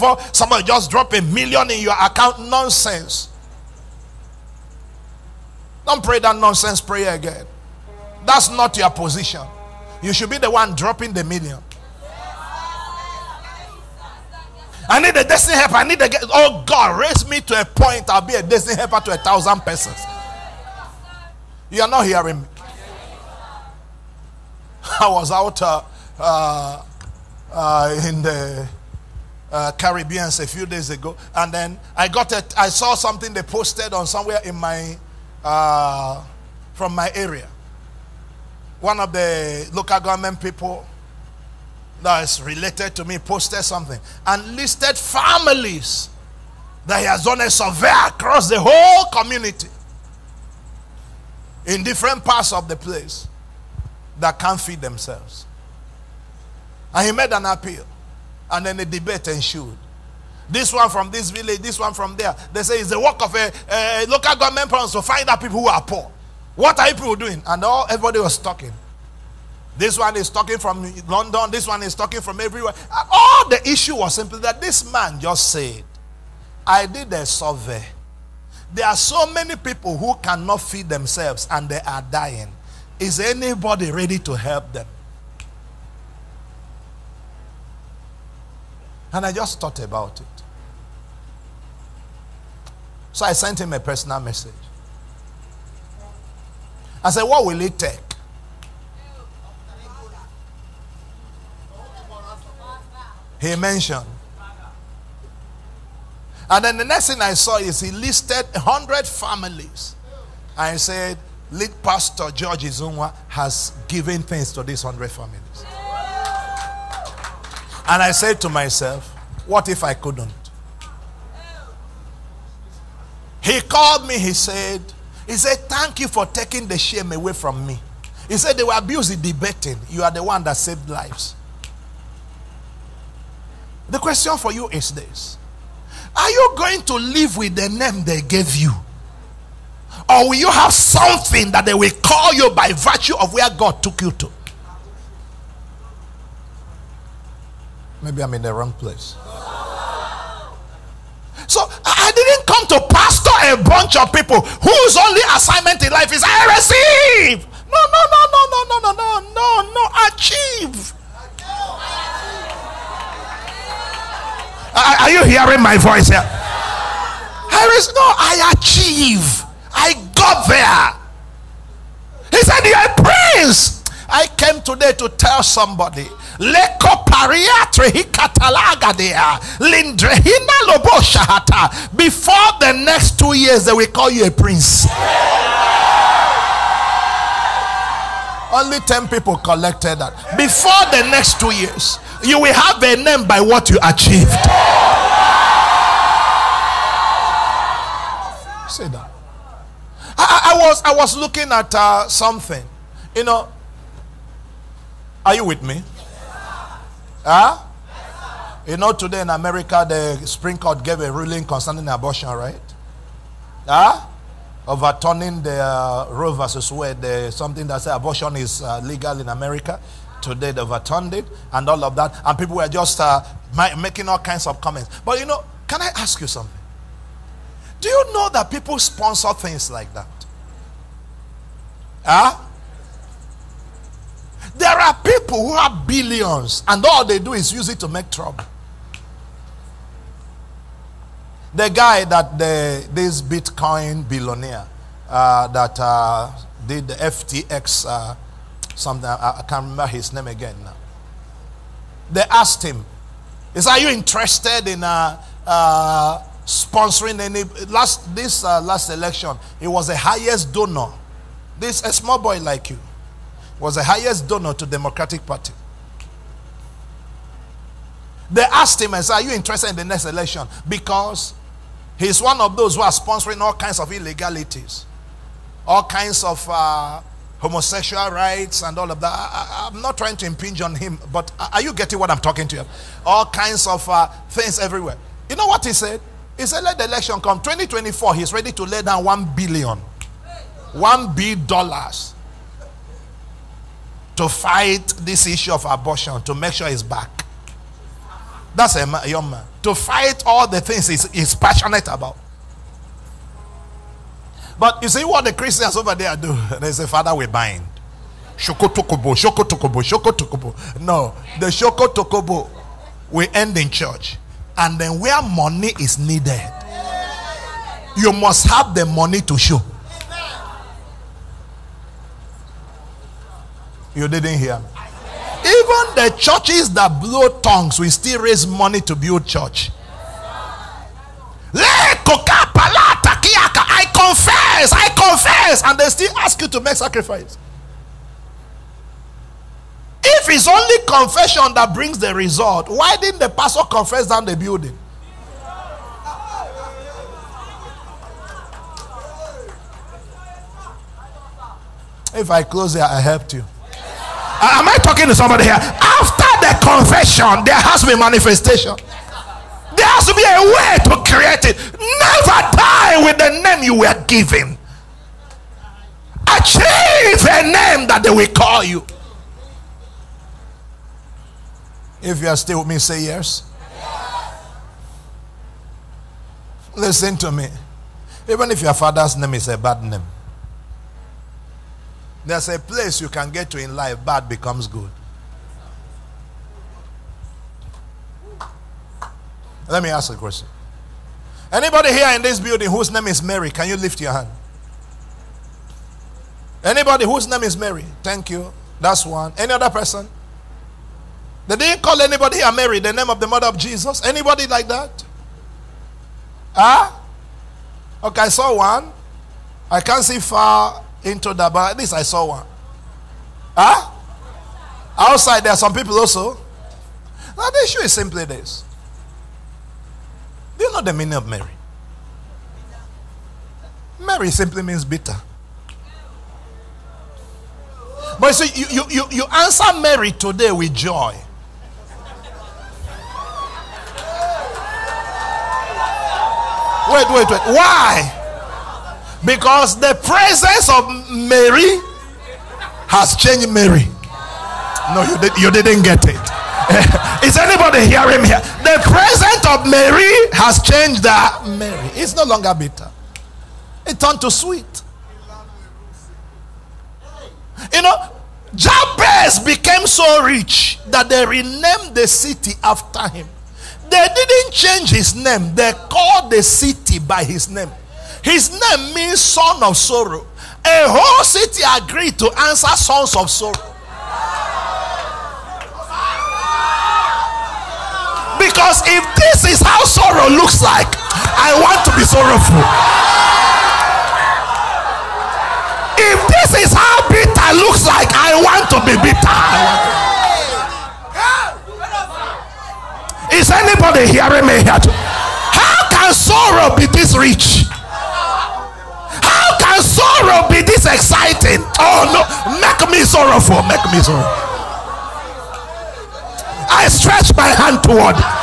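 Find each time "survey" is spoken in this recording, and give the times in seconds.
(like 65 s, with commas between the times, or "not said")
47 s, 77 s.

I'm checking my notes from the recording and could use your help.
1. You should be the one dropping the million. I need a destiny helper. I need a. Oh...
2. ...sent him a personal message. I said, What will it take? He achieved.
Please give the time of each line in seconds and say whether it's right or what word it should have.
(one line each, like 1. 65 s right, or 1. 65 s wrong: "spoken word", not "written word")
1. 10 s right
2. 93 s wrong: "mentioned", not "achieved".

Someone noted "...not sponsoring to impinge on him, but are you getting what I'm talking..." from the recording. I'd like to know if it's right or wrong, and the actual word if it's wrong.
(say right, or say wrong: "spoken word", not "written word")
wrong: "trying", not "sponsoring".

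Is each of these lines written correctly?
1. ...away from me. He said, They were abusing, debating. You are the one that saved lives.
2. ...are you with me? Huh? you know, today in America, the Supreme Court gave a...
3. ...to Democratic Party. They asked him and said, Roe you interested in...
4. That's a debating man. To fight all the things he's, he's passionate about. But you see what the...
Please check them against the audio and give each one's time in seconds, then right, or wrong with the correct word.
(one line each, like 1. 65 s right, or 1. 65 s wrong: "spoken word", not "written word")
1. 127 s right
2. 205 s right
3. 264 s wrong: "Are", not "Roe"
4. 298 s wrong: "young", not "debating".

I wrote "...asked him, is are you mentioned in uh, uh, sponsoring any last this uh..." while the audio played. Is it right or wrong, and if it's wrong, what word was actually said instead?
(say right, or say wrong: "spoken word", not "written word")
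wrong: "interested", not "mentioned".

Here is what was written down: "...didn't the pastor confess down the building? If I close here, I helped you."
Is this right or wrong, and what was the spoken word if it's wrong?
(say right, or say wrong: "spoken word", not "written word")
right.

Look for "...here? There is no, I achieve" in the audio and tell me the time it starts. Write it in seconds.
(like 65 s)
166 s.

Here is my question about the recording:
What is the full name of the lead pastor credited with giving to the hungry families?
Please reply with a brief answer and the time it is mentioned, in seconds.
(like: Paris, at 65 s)
George Izunwa, at 112 s.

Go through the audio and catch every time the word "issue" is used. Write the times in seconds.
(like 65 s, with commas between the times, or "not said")
73 s, 295 s, 417 s.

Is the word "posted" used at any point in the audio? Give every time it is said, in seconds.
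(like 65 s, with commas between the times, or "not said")
33 s, 43 s.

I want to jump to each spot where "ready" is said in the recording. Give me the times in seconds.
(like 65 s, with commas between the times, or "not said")
83 s, 288 s.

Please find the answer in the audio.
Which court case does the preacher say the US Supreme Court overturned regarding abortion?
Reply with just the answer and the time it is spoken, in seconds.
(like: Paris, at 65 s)
Roe versus Wade, at 216 s.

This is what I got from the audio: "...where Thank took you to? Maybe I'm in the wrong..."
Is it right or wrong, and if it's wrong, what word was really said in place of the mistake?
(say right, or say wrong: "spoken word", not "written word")
wrong: "God", not "Thank".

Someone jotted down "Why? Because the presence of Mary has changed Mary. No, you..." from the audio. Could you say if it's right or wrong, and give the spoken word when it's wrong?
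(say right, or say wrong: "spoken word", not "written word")
right.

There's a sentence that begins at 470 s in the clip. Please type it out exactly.
A whole city agreed to answer sons of sorrow.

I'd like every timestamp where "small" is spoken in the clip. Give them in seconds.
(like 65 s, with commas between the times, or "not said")
261 s.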